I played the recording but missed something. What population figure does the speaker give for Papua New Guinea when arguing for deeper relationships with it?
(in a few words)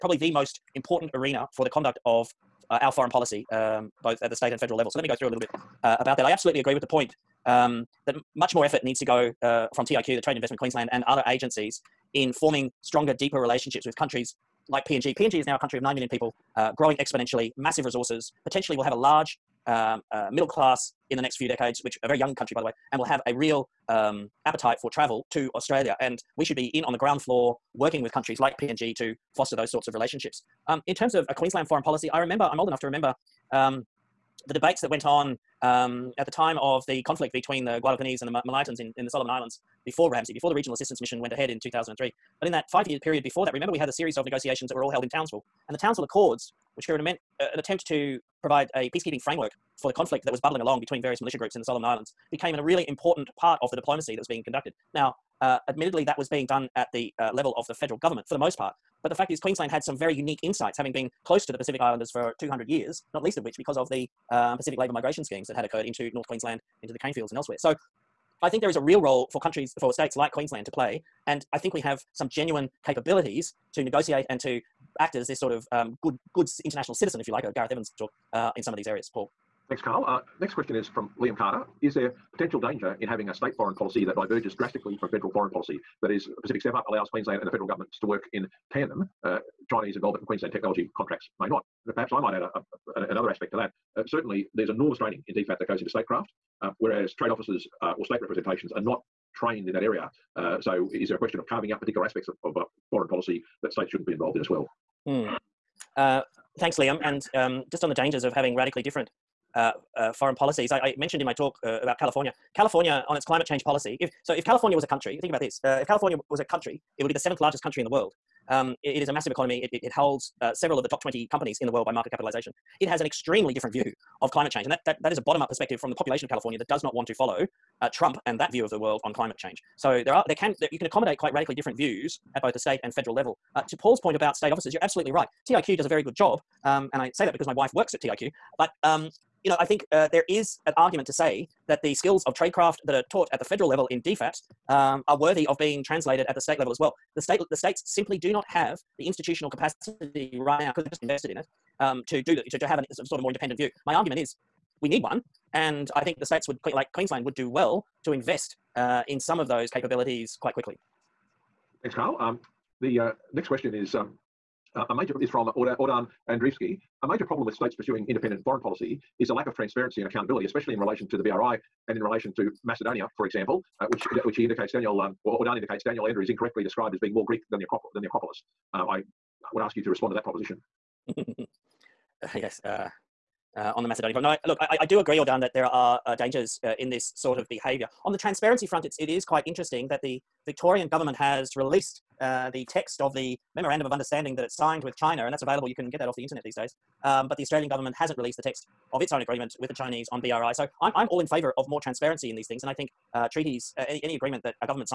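9 million.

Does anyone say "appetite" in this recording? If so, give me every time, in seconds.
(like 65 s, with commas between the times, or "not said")
24 s.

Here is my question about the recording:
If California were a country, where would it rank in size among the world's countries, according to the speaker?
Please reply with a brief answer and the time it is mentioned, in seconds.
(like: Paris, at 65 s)
seventh largest, at 117 s.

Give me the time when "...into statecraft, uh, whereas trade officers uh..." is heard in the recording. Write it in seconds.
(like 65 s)
95 s.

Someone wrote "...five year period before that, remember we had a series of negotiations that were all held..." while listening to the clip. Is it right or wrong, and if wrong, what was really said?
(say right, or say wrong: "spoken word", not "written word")
right.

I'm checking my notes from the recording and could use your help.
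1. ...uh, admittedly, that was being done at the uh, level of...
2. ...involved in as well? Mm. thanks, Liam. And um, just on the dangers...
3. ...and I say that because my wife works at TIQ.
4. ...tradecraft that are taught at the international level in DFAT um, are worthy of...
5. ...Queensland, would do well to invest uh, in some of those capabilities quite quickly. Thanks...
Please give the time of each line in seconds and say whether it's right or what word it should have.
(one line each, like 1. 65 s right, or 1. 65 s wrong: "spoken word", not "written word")
1. 55 s right
2. 104 s right
3. 136 s right
4. 142 s wrong: "federal", not "international"
5. 156 s right.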